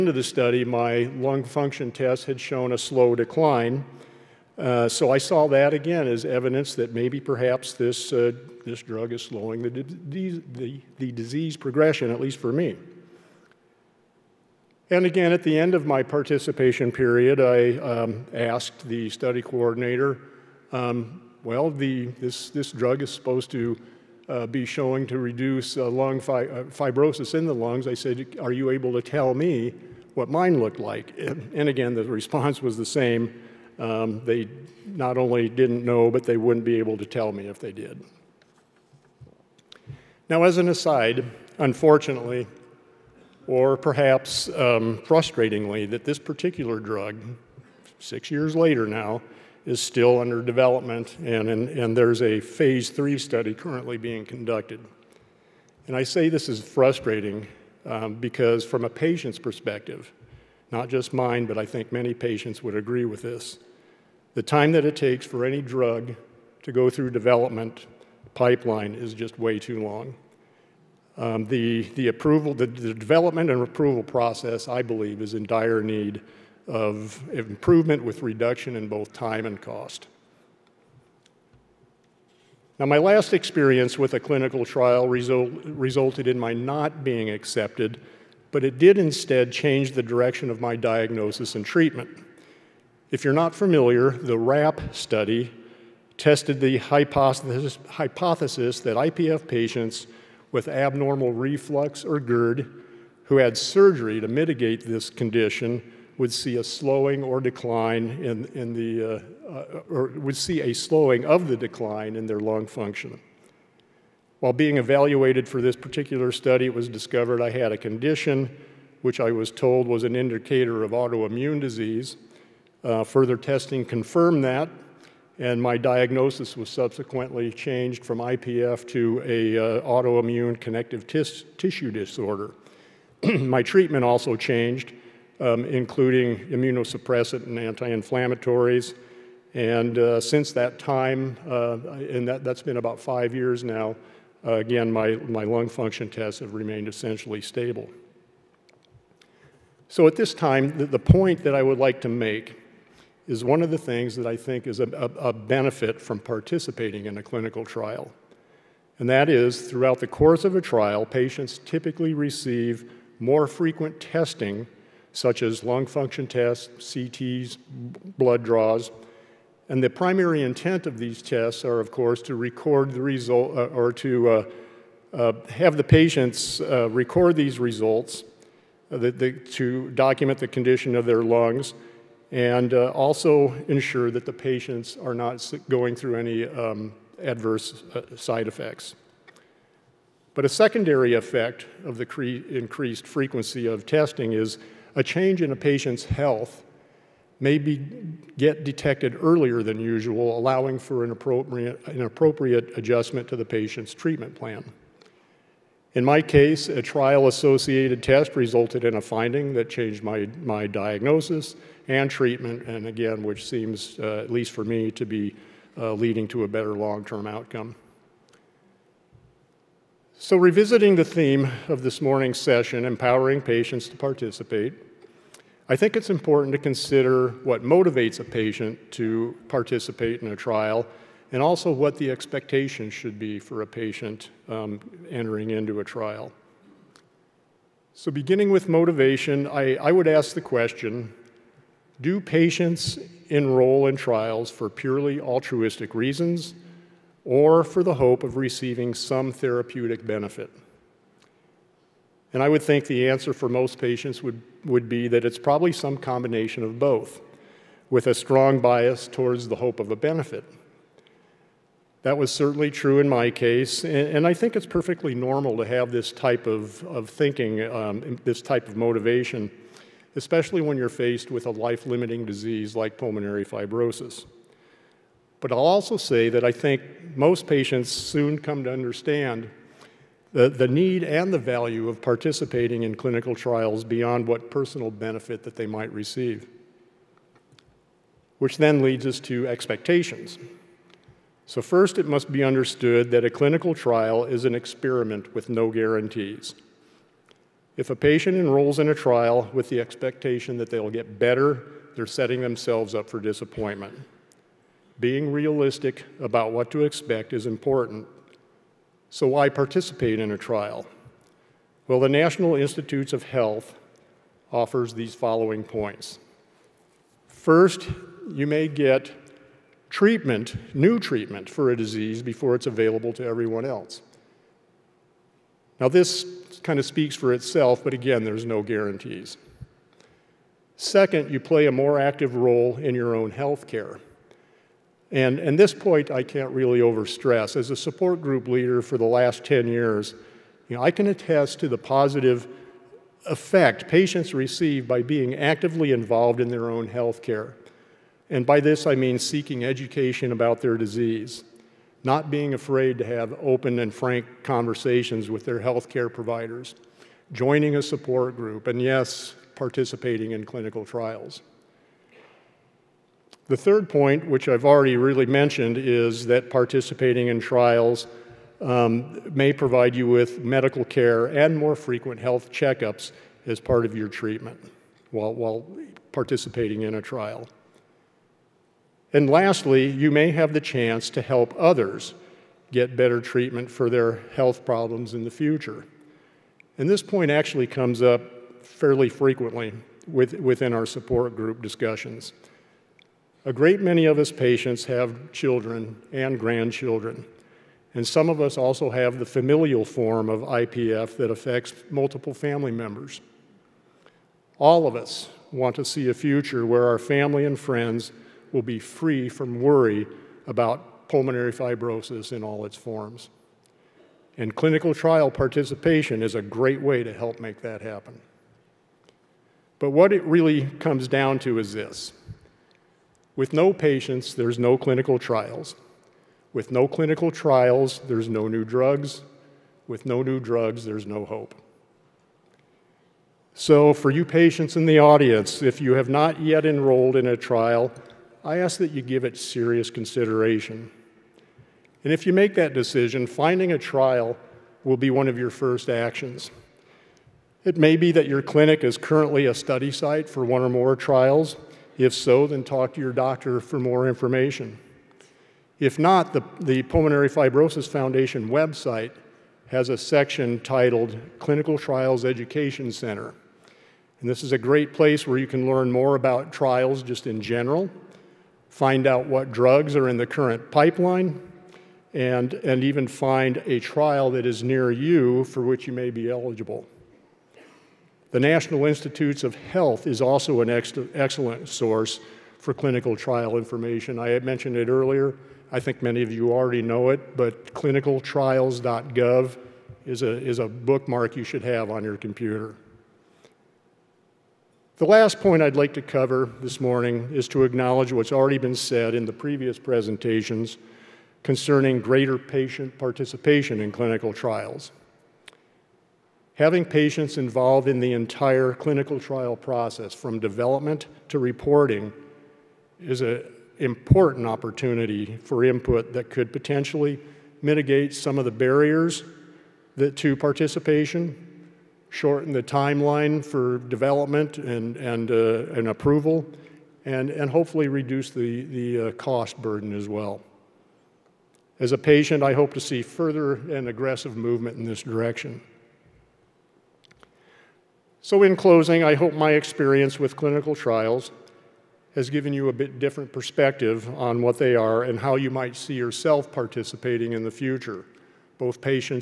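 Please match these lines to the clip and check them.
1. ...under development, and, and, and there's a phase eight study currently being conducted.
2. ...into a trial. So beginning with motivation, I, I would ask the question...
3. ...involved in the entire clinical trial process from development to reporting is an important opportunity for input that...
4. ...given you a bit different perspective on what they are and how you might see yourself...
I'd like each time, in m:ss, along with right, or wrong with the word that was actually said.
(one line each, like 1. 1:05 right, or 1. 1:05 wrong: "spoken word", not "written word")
1. 0:50 wrong: "three", not "eight"
2. 3:55 right
3. 8:27 right
4. 9:02 right.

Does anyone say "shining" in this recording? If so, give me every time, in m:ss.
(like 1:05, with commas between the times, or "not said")
not said.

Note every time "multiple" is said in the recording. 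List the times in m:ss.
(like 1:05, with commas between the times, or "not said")
6:41.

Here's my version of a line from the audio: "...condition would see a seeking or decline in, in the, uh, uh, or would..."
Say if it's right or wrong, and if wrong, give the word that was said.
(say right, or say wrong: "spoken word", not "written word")
wrong: "slowing", not "seeking".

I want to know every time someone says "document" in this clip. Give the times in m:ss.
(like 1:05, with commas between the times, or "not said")
2:59.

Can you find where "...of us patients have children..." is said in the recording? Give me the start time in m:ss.
6:34.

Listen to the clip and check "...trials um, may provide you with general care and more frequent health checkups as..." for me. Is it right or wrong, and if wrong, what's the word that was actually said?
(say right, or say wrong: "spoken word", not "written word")
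wrong: "medical", not "general".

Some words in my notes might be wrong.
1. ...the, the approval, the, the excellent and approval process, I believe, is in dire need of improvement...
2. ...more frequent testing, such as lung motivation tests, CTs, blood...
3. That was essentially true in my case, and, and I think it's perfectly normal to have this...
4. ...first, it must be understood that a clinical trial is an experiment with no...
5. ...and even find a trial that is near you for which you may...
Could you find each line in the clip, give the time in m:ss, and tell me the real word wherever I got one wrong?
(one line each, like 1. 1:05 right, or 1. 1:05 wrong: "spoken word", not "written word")
1. 1:11 wrong: "development", not "excellent"
2. 2:43 wrong: "function", not "motivation"
3. 4:22 wrong: "certainly", not "essentially"
4. 4:51 right
5. 7:52 right.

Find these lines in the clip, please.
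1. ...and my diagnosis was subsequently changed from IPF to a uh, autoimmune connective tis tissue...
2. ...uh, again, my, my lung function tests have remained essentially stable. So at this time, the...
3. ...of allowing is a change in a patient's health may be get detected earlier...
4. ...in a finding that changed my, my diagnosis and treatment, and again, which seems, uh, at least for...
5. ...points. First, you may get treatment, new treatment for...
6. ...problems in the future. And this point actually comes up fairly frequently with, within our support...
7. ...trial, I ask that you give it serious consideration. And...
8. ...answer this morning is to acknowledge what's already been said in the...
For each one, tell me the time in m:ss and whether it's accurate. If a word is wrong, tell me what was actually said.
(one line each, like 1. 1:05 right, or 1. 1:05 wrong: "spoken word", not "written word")
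1. 2:05 right
2. 2:24 right
3. 3:13 wrong: "testing", not "allowing"
4. 3:28 right
5. 5:15 right
6. 6:24 right
7. 7:17 right
8. 8:16 wrong: "cover", not "answer".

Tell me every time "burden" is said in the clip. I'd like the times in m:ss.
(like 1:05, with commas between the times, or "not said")
8:49.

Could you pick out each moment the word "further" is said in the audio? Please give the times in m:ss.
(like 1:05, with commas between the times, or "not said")
2:03, 8:53.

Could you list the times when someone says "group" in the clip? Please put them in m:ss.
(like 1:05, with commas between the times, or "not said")
5:38, 5:58, 6:31.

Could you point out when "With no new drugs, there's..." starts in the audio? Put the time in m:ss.
7:09.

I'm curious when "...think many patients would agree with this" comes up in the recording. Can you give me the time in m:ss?
1:01.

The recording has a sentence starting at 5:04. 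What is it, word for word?
Being realistic about what to expect is important so why participate in a trial?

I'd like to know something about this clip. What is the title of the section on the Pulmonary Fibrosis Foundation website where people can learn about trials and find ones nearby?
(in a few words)
Clinical Trials Education Center.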